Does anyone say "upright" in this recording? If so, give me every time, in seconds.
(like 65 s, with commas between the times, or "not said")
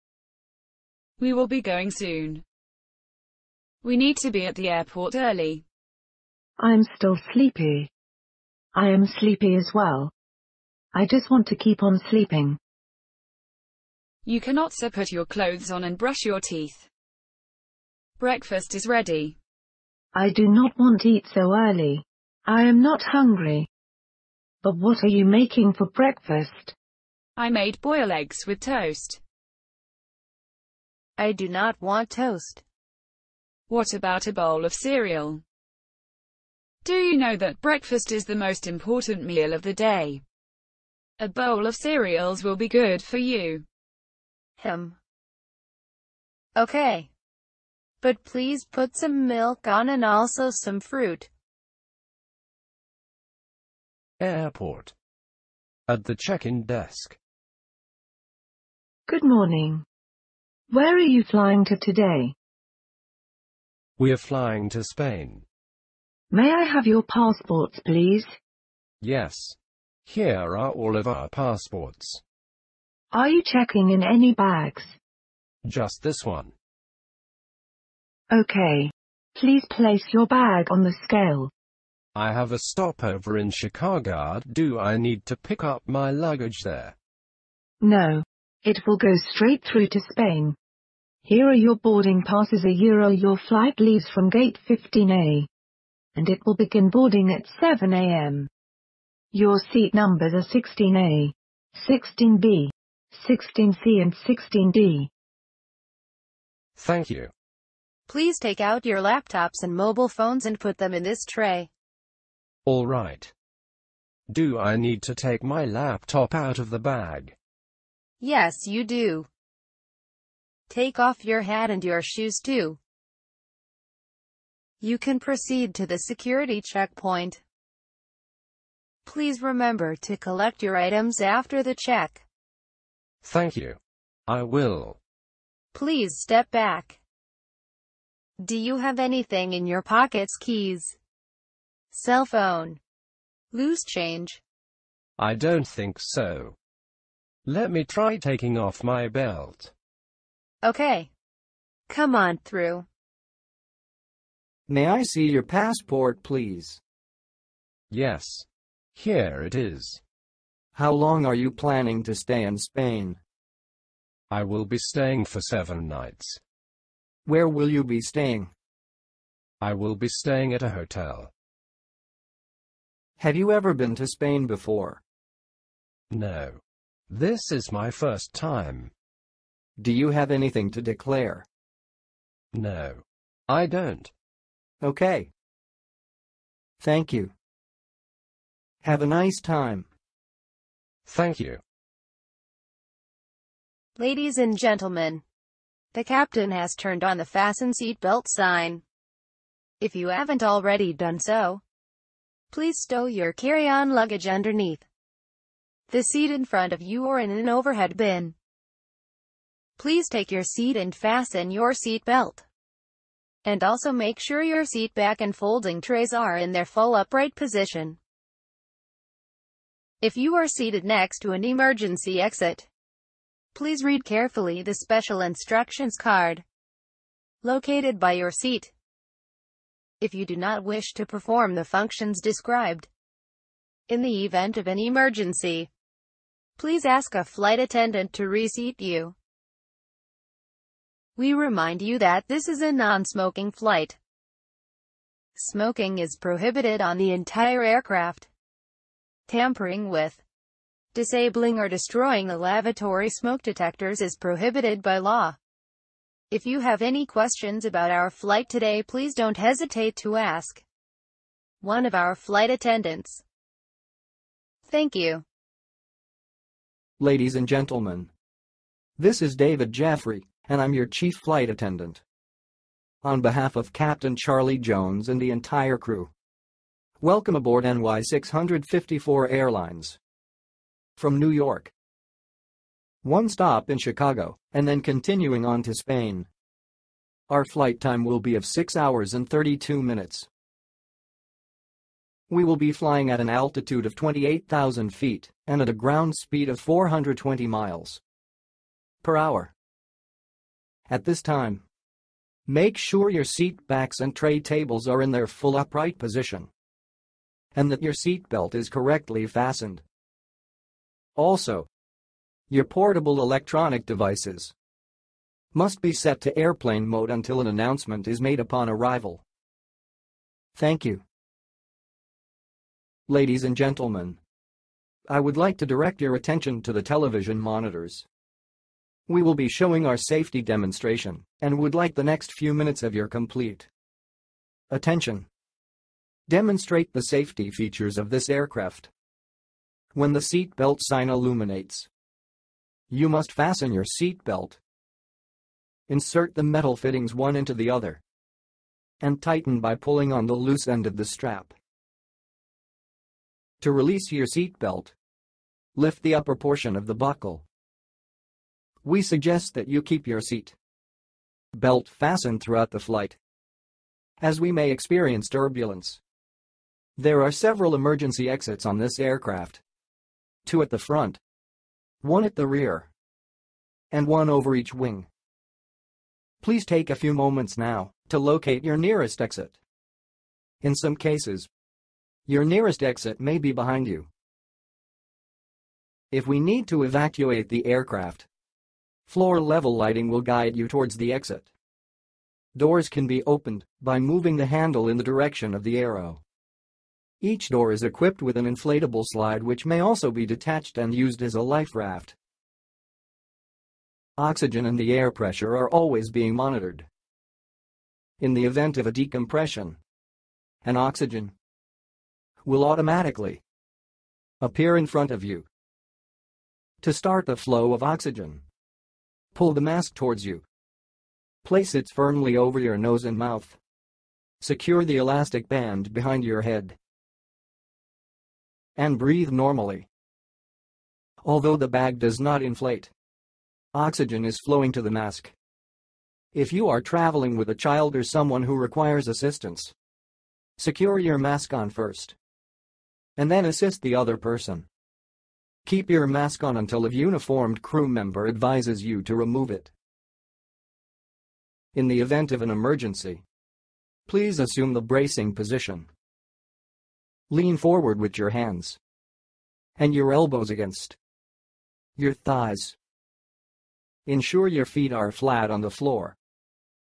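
216 s, 305 s.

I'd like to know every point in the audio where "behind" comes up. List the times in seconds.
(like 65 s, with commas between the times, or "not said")
383 s, 425 s.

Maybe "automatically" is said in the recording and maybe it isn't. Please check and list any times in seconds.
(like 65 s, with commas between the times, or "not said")
412 s.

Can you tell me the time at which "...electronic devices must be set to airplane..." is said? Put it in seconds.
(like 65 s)
313 s.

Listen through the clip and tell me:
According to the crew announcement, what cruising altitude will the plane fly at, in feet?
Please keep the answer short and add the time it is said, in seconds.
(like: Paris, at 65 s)
28,000 feet, at 293 s.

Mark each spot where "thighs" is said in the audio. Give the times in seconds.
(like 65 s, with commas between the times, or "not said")
462 s.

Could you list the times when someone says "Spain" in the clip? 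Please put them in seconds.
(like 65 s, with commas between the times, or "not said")
64 s, 90 s, 162 s, 174 s, 285 s.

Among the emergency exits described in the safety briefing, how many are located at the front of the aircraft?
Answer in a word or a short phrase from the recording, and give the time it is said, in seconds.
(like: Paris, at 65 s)
2, at 370 s.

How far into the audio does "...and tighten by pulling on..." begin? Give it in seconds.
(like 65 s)
349 s.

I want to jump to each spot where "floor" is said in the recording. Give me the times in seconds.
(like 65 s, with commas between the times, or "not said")
389 s, 465 s.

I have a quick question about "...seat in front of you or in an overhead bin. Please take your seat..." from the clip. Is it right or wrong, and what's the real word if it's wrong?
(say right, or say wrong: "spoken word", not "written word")
right.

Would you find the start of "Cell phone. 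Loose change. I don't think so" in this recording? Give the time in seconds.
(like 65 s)
141 s.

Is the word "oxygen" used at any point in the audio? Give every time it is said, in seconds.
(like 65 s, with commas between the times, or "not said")
404 s, 410 s, 417 s, 433 s.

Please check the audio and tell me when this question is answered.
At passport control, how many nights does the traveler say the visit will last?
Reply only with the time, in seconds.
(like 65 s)
165 s.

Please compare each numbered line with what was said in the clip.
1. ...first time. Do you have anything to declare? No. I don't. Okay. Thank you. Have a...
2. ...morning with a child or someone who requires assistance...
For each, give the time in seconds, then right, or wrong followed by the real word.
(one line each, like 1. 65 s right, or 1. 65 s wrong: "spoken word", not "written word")
1. 177 s right
2. 436 s wrong: "traveling", not "morning".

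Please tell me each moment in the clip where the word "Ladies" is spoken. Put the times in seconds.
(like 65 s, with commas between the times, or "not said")
193 s, 266 s, 323 s.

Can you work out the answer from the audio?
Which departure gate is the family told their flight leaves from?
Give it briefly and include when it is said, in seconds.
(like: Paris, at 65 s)
15A, at 94 s.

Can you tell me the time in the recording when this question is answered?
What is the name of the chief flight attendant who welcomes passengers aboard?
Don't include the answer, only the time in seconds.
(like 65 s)
269 s.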